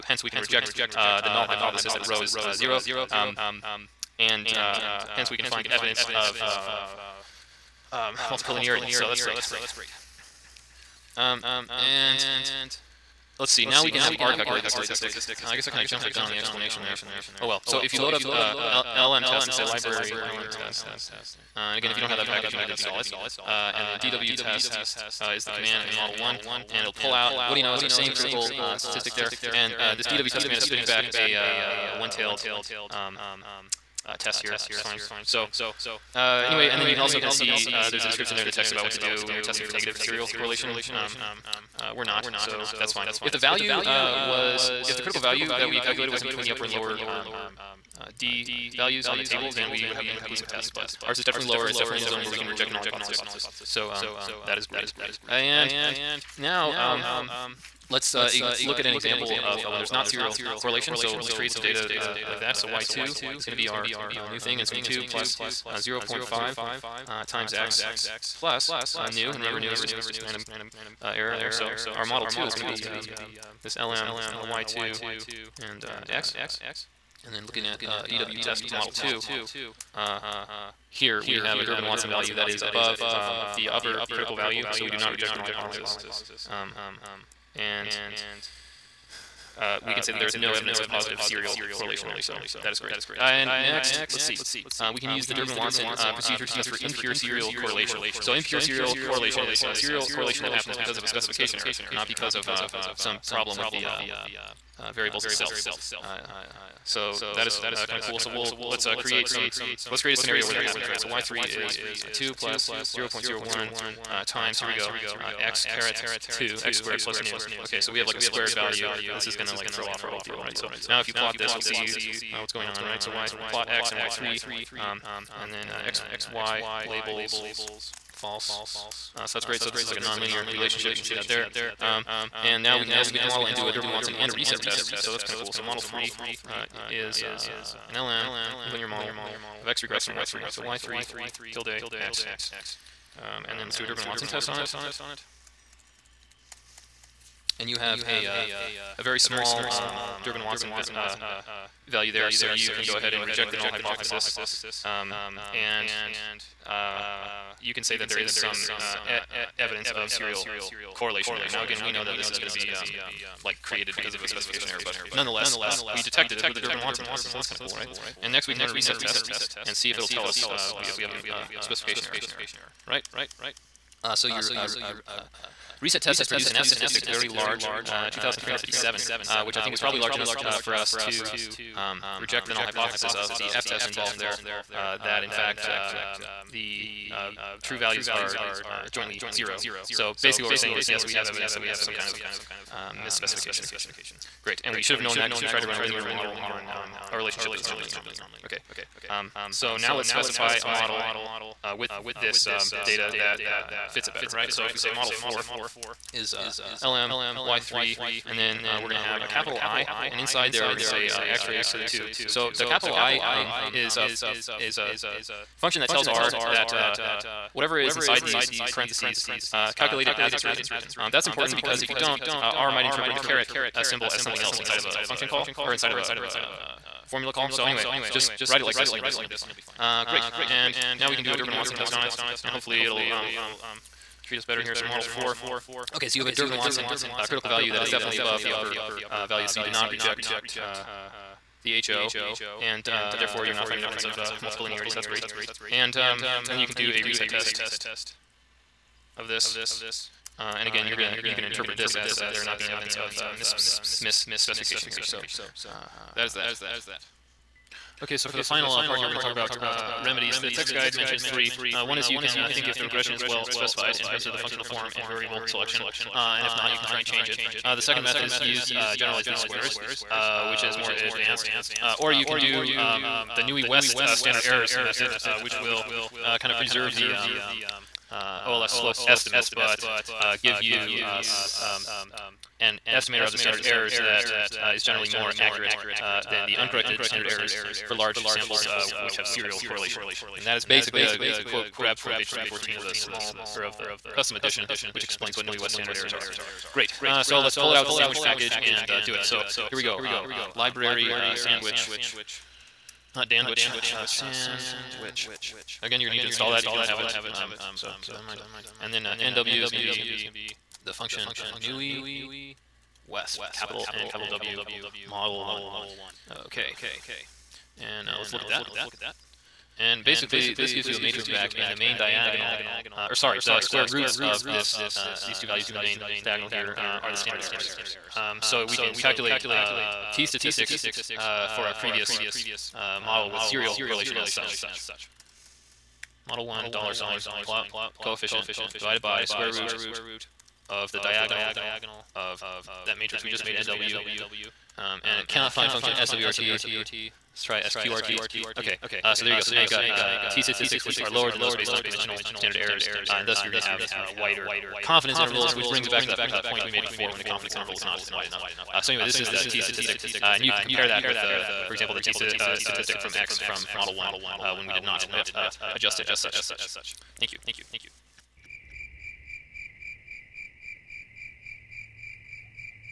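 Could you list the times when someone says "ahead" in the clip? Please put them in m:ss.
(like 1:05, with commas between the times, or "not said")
2:32.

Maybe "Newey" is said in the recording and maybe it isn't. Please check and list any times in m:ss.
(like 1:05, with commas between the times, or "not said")
4:33, 4:55, 5:11.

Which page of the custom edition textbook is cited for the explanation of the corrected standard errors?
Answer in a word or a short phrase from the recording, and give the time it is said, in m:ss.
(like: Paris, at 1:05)
314, at 4:52.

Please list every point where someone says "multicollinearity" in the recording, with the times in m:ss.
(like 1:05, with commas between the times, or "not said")
0:08, 4:04.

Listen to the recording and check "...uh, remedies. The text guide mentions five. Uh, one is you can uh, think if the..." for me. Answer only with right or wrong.
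wrong.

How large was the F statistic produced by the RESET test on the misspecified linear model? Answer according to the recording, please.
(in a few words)
2,357.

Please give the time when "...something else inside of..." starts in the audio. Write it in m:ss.
3:44.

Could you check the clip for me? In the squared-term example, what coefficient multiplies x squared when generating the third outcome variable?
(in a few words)
0.01.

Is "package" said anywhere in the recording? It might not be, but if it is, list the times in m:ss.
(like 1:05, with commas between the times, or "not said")
0:22, 4:58.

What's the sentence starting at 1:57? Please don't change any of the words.
Okay, so we have like a squared value.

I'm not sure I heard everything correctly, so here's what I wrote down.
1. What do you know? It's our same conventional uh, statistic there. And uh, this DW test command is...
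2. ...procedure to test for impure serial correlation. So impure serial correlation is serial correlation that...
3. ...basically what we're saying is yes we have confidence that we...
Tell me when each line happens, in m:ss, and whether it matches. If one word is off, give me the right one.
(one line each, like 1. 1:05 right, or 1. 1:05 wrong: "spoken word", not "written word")
1. 0:27 wrong: "critical", not "conventional"
2. 1:36 right
3. 3:10 wrong: "evidence", not "confidence".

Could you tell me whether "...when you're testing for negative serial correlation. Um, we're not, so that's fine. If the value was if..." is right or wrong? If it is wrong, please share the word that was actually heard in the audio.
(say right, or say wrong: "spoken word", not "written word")
right.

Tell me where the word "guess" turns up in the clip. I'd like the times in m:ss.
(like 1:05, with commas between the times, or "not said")
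0:15.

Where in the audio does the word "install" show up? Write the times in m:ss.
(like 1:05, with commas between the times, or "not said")
0:22, 5:06.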